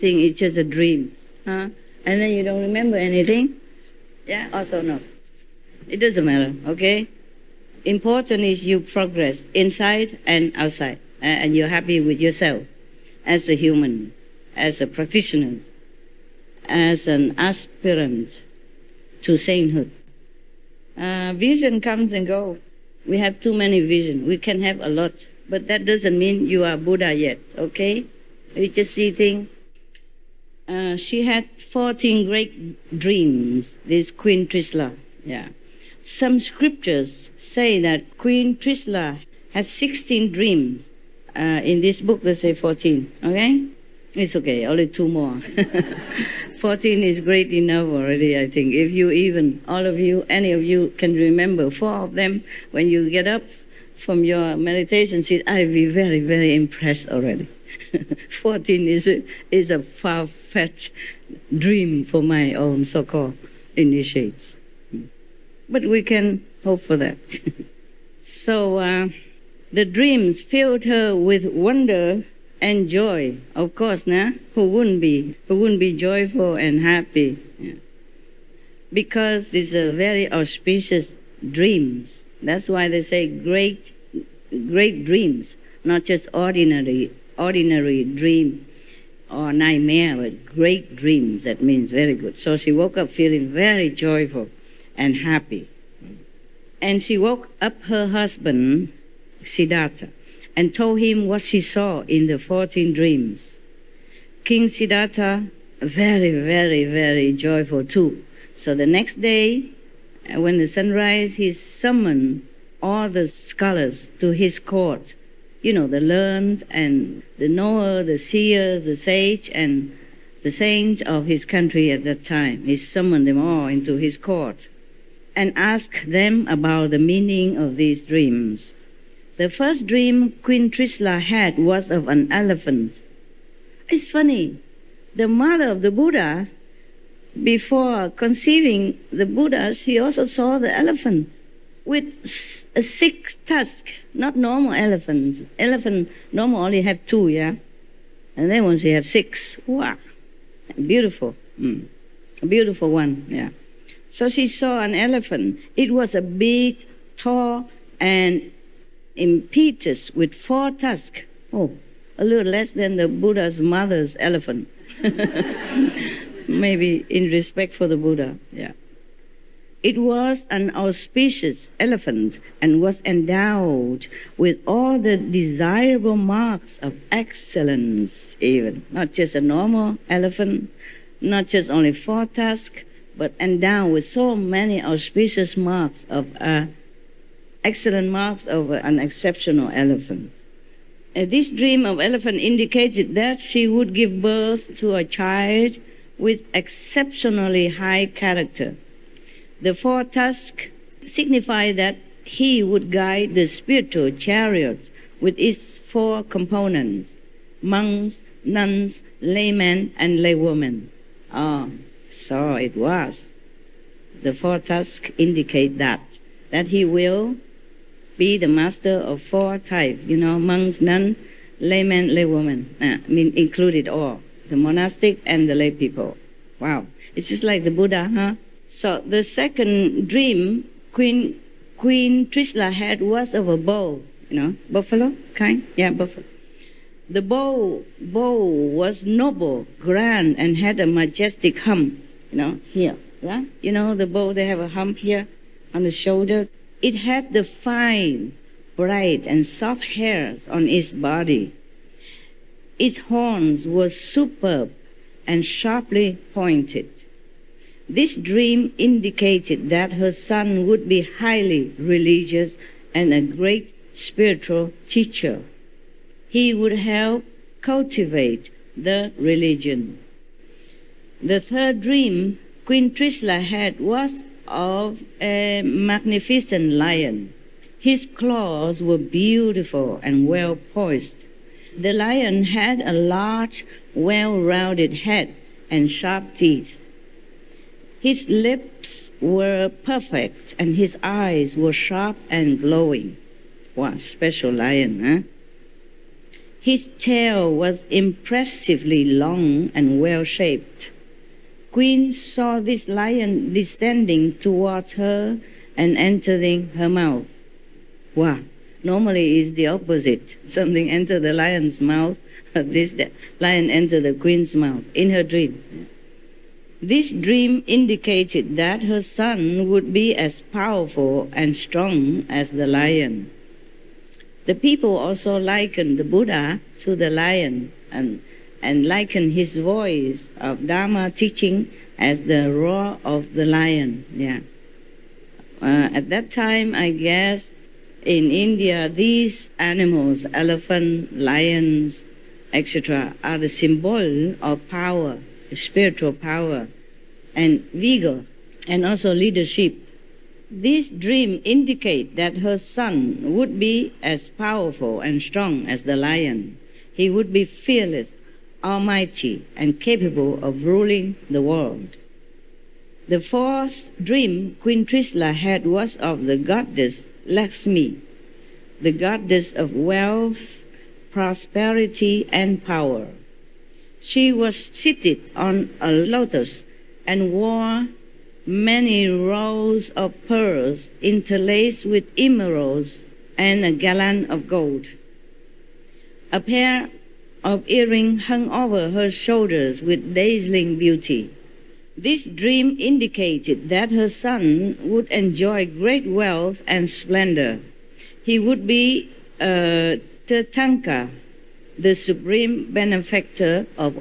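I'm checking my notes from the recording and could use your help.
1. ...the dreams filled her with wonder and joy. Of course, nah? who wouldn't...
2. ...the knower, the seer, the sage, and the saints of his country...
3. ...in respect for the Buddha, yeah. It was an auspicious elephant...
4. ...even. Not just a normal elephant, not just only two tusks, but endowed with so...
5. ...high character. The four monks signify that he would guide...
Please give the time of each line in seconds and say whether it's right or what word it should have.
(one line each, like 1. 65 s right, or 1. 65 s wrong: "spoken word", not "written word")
1. 69 s right
2. 117 s right
3. 167 s right
4. 178 s wrong: "four", not "two"
5. 197 s wrong: "tusks", not "monks".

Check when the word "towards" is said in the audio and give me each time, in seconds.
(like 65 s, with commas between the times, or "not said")
304 s.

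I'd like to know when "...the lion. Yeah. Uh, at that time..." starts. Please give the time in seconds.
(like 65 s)
333 s.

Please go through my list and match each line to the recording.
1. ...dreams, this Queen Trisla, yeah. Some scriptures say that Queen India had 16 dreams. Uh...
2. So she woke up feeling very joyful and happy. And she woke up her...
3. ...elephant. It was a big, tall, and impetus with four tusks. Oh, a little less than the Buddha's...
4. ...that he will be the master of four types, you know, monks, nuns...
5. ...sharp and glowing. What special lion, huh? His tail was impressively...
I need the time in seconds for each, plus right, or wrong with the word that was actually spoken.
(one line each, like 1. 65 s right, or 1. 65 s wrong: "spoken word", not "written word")
1. 32 s wrong: "Trisla", not "India"
2. 92 s right
3. 154 s right
4. 216 s right
5. 291 s right.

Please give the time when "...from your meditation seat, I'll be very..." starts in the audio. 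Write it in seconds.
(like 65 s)
53 s.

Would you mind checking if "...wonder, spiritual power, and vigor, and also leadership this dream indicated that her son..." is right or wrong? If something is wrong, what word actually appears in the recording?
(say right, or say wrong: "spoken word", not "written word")
wrong: "power", not "wonder".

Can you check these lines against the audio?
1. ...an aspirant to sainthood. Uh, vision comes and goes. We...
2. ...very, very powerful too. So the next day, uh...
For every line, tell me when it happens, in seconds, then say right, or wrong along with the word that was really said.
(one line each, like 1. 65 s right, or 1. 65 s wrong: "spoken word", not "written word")
1. 17 s right
2. 106 s wrong: "joyful", not "powerful".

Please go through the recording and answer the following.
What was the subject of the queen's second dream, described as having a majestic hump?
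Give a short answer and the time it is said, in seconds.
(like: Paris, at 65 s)
A bull, at 233 s.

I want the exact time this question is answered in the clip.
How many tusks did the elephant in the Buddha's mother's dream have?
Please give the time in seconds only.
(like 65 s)
142 s.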